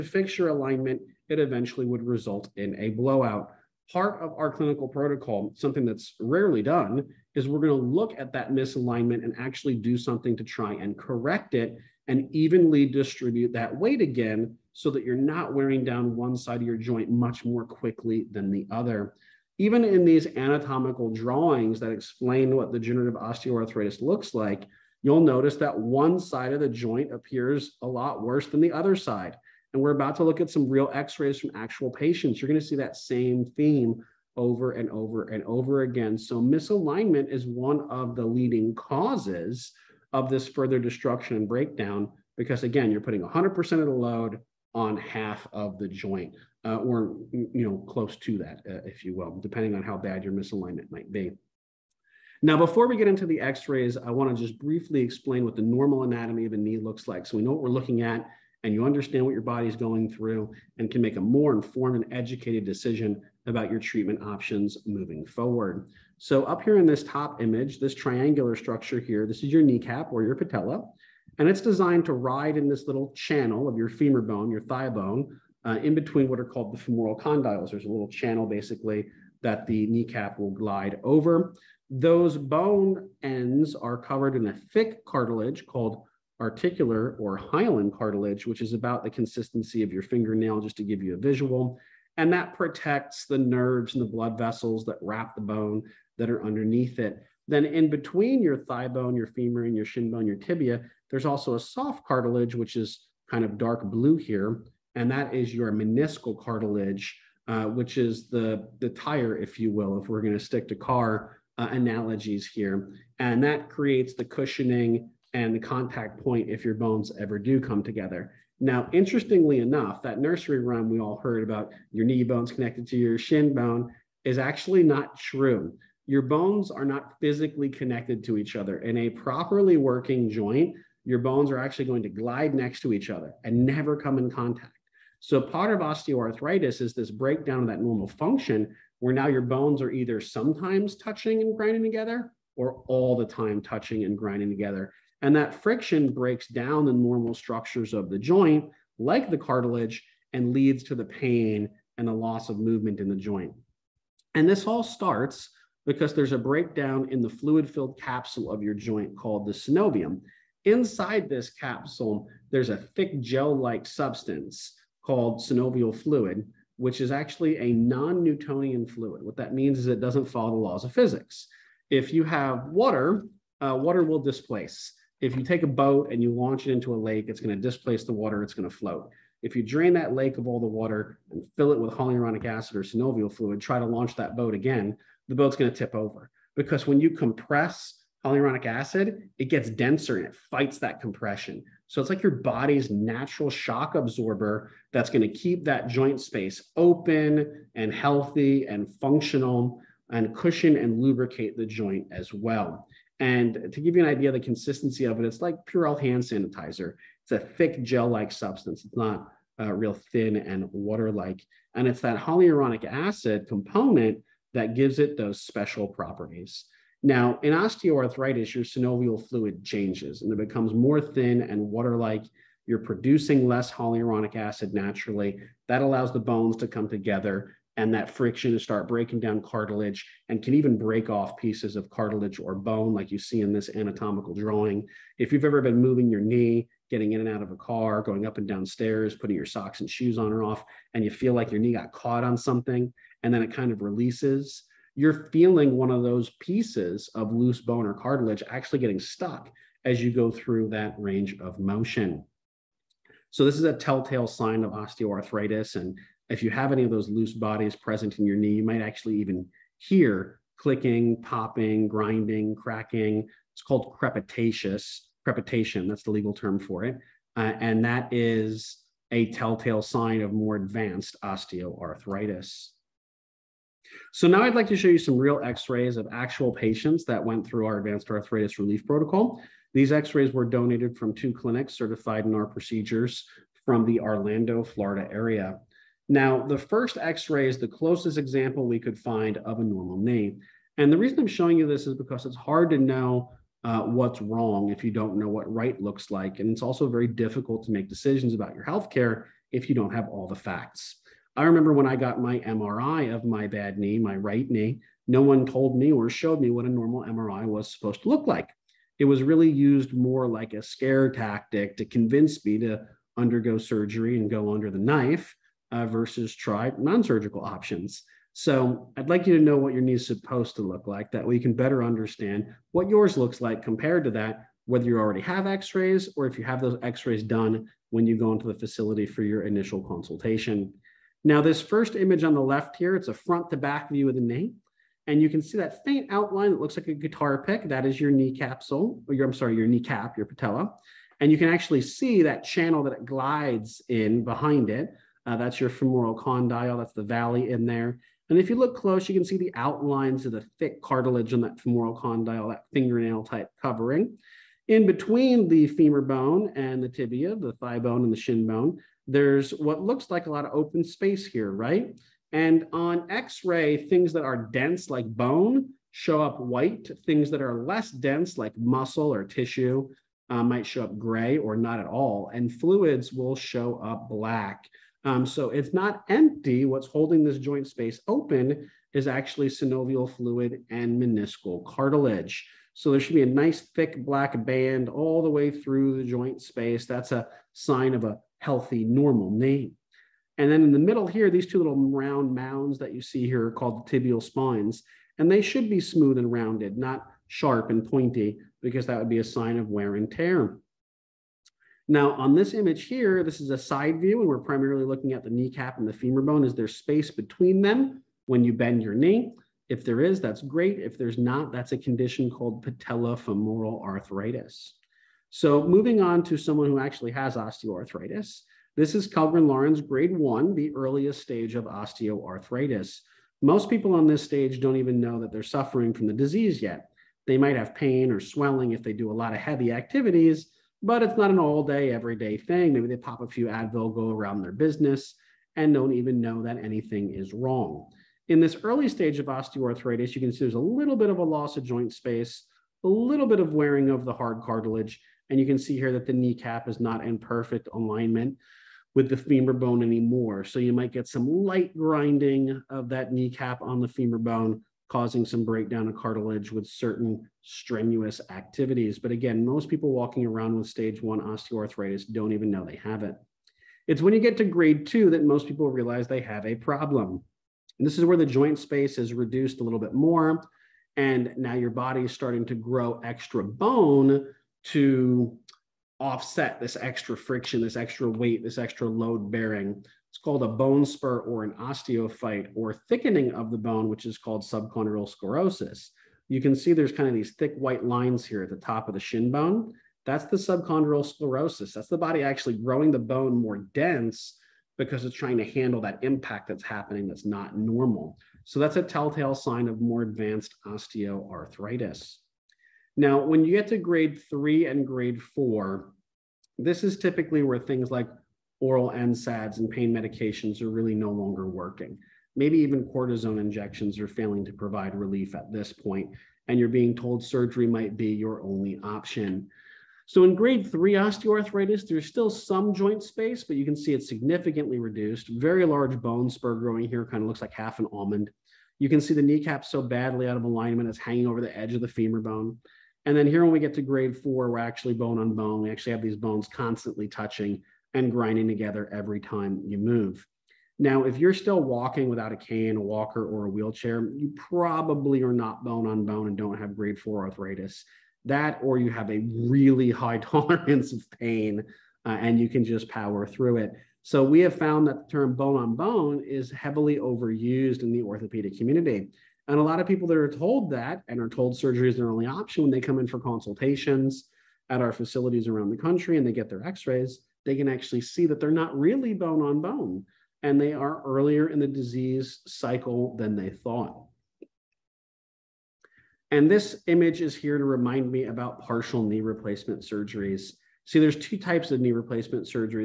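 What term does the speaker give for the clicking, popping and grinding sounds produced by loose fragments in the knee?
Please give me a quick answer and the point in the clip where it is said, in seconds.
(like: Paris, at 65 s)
crepitation, at 265 s.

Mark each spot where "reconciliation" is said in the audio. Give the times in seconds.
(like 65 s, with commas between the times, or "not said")
not said.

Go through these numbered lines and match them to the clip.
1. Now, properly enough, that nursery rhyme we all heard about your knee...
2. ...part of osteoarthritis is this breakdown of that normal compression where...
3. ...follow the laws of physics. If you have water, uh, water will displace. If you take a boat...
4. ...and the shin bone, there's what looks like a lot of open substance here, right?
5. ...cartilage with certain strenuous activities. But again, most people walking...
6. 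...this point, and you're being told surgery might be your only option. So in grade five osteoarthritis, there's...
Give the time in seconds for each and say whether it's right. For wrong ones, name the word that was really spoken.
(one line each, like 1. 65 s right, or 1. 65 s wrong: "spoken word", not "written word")
1. 118 s wrong: "interestingly", not "properly"
2. 135 s wrong: "function", not "compression"
3. 170 s right
4. 358 s wrong: "space", not "substance"
5. 455 s right
6. 515 s wrong: "three", not "five".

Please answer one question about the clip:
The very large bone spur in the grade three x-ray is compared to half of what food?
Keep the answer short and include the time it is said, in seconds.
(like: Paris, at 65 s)
an almond, at 527 s.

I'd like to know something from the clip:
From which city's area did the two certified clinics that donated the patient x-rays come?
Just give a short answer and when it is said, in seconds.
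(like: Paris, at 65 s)
Orlando, Florida, at 283 s.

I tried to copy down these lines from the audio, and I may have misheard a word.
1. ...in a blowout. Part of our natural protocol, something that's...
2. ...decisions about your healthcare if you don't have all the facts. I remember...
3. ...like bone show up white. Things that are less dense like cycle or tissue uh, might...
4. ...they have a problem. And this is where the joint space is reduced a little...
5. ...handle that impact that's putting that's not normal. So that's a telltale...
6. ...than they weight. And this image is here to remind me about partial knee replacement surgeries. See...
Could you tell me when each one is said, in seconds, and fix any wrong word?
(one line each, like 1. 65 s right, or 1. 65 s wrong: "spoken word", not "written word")
1. 2 s wrong: "clinical", not "natural"
2. 297 s right
3. 364 s wrong: "muscle", not "cycle"
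4. 466 s right
5. 495 s wrong: "happening", not "putting"
6. 573 s wrong: "thought", not "weight".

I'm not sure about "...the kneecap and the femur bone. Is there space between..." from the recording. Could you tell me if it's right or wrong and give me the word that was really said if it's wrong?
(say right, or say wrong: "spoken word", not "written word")
right.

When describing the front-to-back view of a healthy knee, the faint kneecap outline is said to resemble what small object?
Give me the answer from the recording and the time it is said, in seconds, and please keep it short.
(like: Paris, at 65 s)
guitar pick, at 336 s.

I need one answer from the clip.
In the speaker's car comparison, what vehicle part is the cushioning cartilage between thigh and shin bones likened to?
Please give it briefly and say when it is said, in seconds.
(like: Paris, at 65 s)
the tire, at 108 s.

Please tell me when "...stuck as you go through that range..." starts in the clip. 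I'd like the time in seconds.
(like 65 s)
248 s.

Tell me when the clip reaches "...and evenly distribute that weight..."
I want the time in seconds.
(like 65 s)
12 s.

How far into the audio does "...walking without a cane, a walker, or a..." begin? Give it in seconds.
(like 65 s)
541 s.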